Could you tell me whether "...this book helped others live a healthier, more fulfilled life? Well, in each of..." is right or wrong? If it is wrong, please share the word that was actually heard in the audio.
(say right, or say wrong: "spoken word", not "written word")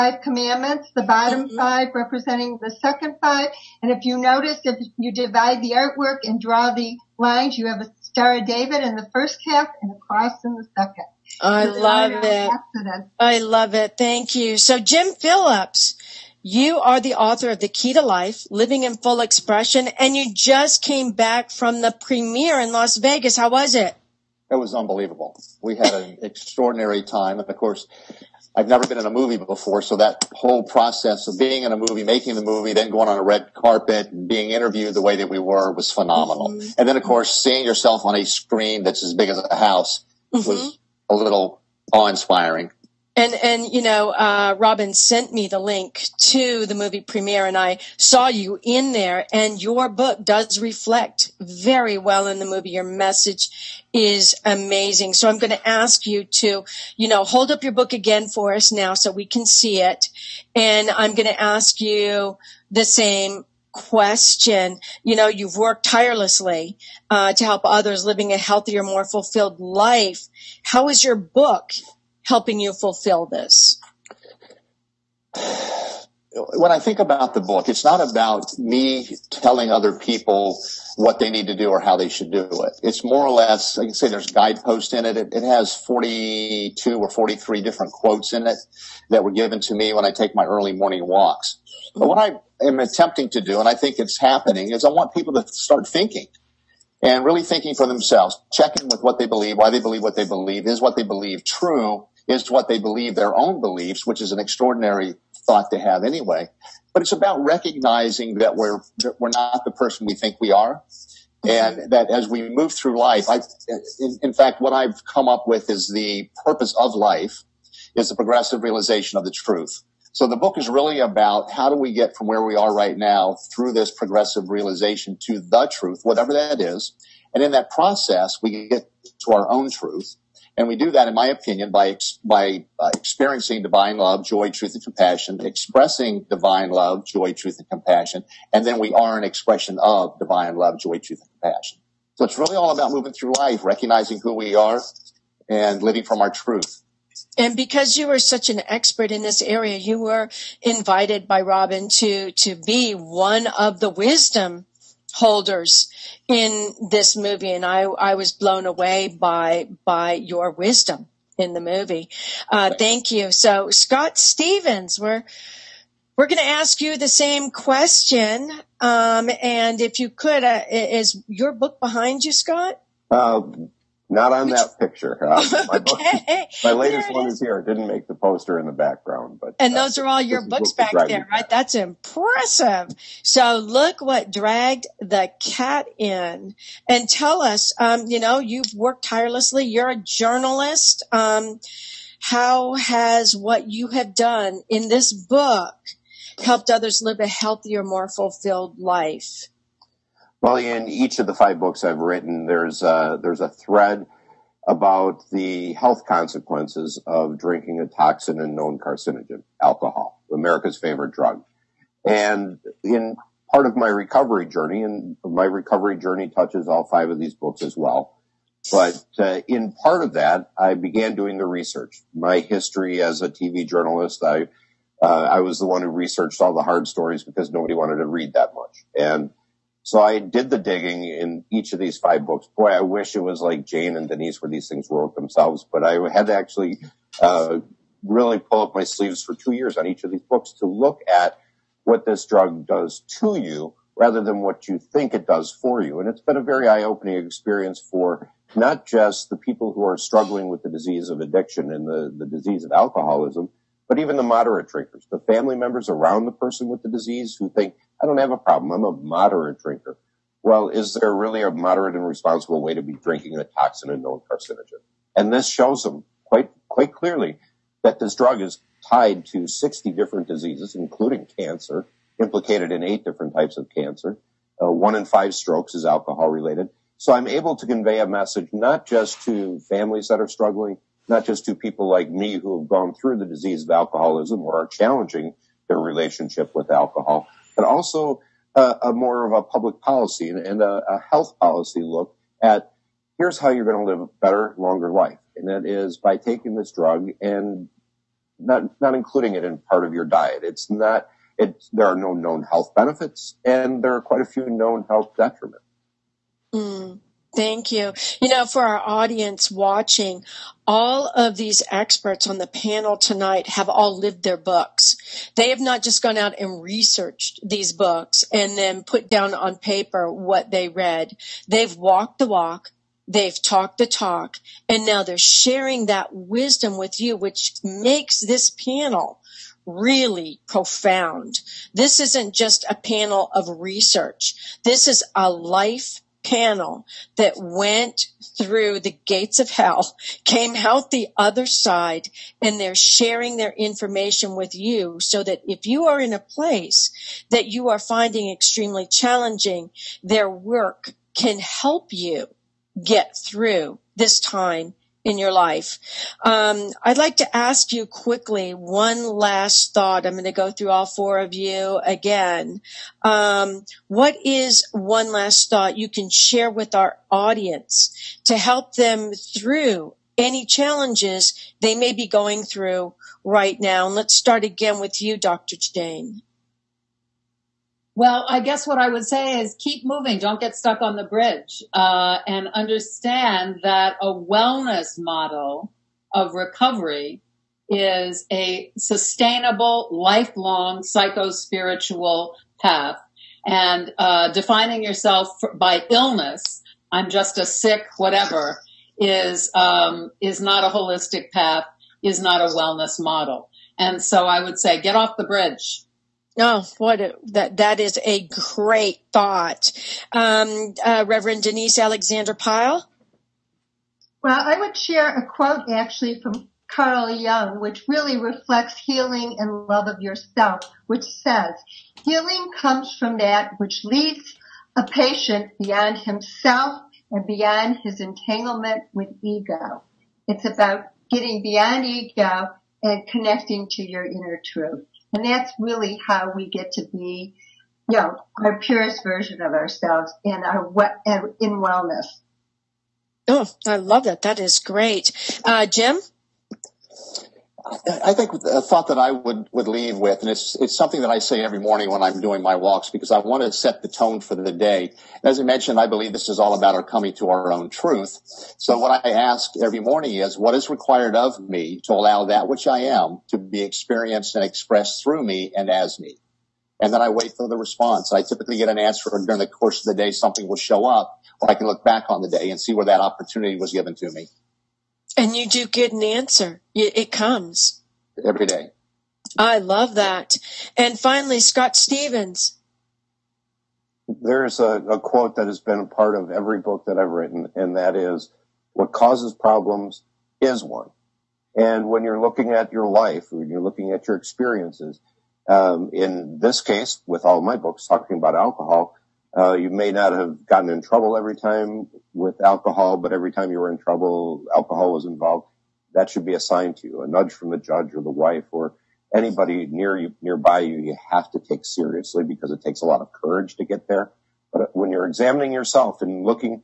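right.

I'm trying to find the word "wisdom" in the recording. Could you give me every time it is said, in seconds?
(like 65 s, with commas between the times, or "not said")
153 s, 160 s, 326 s.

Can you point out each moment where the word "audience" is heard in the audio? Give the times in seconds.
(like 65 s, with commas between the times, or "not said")
308 s, 367 s.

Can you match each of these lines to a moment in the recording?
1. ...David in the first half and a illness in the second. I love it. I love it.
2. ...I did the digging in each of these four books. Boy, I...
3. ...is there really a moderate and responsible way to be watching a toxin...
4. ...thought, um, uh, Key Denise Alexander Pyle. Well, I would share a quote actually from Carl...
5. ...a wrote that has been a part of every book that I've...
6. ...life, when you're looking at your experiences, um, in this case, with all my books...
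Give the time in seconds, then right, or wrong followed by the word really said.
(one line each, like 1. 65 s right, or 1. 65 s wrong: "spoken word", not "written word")
1. 8 s wrong: "cross", not "illness"
2. 229 s wrong: "five", not "four"
3. 260 s wrong: "drinking", not "watching"
4. 409 s wrong: "Reverend", not "Key"
5. 484 s wrong: "quote", not "wrote"
6. 492 s right.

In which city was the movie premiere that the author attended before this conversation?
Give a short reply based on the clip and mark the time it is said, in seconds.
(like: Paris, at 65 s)
Las Vegas, at 22 s.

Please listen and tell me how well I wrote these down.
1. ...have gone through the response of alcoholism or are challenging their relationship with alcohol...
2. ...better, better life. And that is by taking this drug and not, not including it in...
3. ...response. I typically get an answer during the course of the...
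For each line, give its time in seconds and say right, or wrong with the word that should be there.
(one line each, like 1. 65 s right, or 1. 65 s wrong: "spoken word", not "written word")
1. 282 s wrong: "disease", not "response"
2. 294 s wrong: "longer", not "better"
3. 467 s right.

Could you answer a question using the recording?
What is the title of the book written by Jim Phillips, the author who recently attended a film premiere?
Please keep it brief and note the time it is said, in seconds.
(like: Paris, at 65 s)
The Key to Life, at 17 s.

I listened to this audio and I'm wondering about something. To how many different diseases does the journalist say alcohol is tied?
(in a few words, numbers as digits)
60.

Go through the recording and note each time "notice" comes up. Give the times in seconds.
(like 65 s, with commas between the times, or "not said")
4 s.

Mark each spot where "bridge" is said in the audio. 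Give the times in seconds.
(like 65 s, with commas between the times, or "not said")
381 s, 405 s.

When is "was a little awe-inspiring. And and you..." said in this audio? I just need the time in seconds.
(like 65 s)
40 s.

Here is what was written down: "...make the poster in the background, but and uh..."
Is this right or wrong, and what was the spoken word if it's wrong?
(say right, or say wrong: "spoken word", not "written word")
right.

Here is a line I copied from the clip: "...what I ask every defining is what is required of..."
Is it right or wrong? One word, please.
wrong.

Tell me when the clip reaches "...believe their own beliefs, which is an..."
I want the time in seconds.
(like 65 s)
102 s.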